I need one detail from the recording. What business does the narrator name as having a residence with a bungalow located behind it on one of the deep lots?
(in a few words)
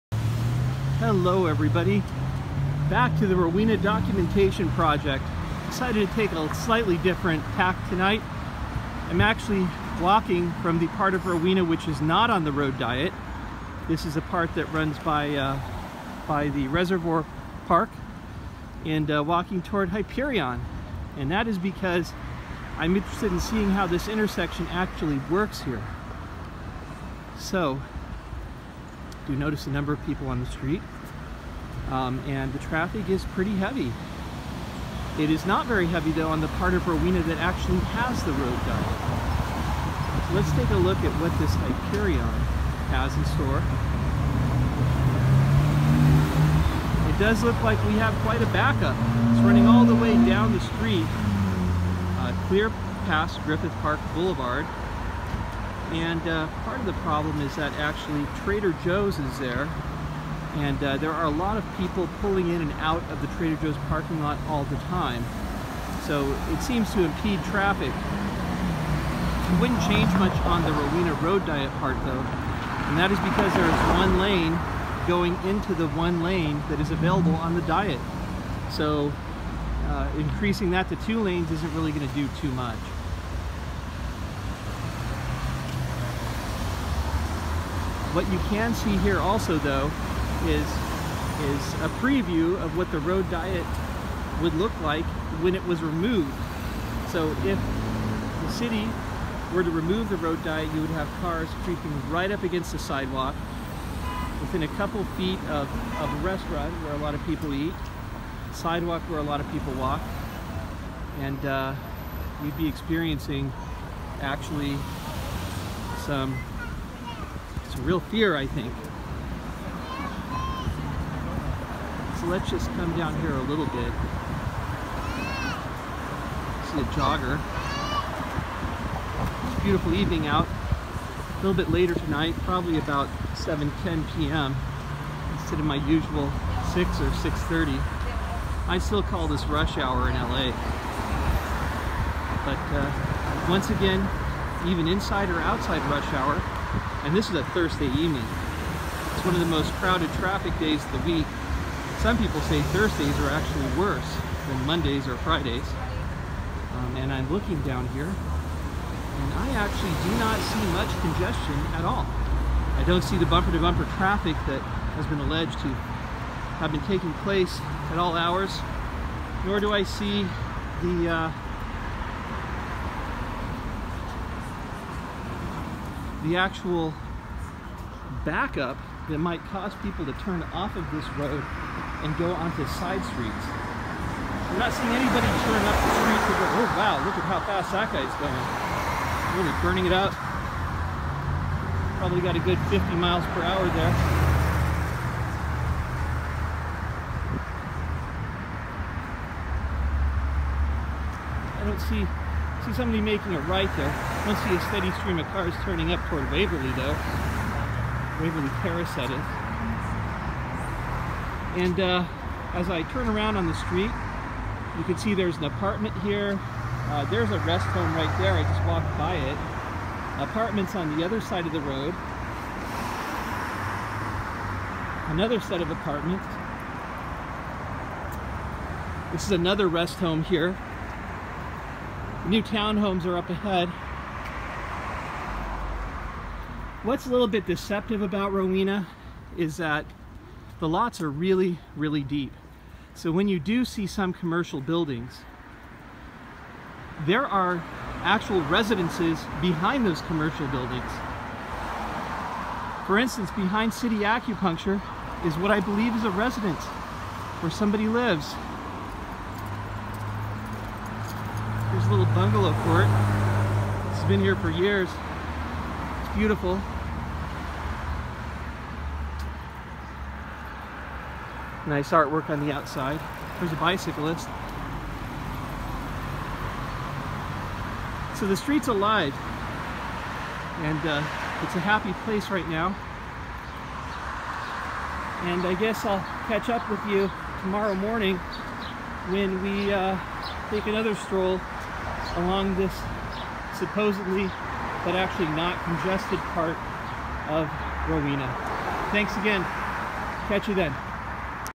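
City Acupuncture.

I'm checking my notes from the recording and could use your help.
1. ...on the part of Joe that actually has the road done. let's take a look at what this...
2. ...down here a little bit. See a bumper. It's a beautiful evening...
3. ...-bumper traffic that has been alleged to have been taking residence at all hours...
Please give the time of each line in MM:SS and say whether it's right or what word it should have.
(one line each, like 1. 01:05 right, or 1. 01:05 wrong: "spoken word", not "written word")
1. 00:36 wrong: "Rowena", not "Joe"
2. 02:02 wrong: "jogger", not "bumper"
3. 02:43 wrong: "place", not "residence".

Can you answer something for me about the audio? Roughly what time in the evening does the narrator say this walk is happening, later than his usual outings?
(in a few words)
7:10 p.m.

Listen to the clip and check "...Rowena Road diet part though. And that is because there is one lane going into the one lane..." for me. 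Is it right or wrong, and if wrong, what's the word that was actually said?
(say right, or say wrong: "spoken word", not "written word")
right.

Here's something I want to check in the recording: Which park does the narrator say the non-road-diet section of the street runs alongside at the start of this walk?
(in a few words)
Reservoir Park.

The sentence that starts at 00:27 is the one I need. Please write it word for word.
So do notice a number of people on the street.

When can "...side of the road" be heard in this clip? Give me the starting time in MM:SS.
03:41.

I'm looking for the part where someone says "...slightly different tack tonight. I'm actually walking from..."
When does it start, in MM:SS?
00:06.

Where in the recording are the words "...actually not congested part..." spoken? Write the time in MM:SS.
04:54.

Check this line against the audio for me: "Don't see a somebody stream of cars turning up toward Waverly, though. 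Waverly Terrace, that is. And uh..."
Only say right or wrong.
wrong.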